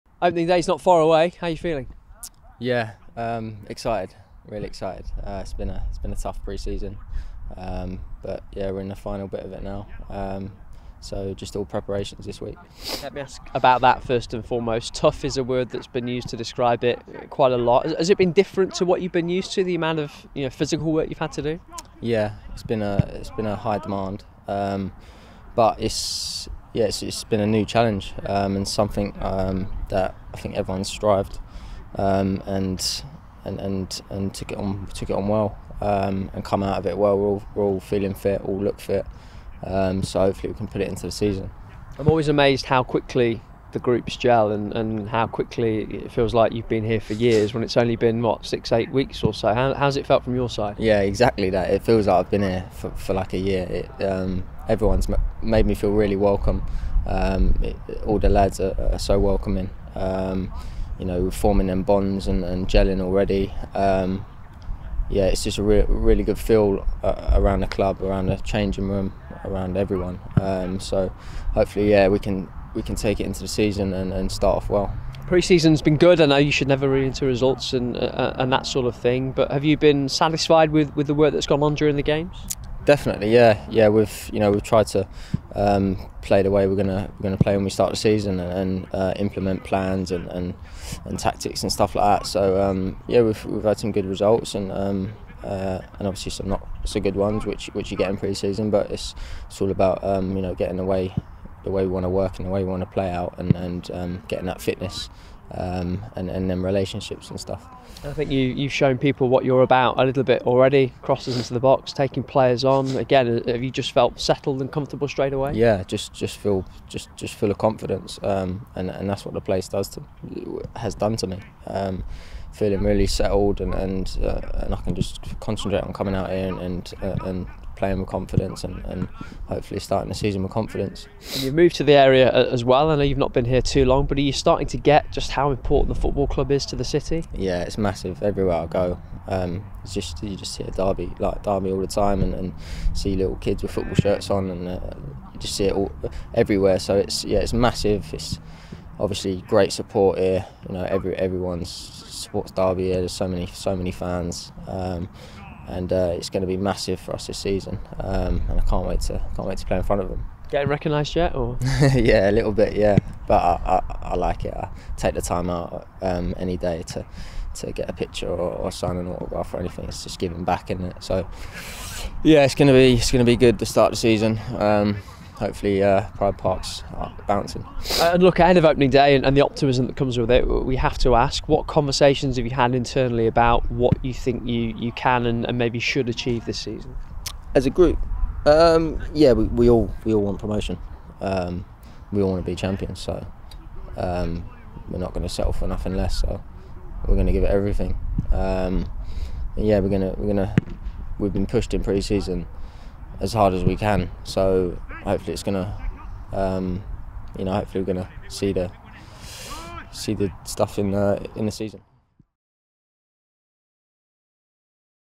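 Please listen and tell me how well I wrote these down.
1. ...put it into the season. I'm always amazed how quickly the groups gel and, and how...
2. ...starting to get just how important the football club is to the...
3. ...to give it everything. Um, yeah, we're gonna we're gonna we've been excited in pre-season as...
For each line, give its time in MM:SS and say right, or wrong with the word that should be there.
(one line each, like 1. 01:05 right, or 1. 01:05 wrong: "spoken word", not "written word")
1. 00:40 right
2. 02:14 right
3. 03:17 wrong: "pushed", not "excited".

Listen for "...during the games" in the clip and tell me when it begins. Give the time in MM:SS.
01:21.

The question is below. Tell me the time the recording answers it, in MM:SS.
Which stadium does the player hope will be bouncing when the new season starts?
02:56.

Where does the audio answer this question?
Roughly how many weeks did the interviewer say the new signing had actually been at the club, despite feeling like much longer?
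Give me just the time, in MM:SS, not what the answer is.
00:48.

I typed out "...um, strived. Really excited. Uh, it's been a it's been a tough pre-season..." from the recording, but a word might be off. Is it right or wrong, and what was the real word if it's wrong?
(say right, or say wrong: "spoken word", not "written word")
wrong: "excited", not "strived".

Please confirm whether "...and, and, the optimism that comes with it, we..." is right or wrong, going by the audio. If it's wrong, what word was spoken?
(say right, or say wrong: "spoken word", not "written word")
right.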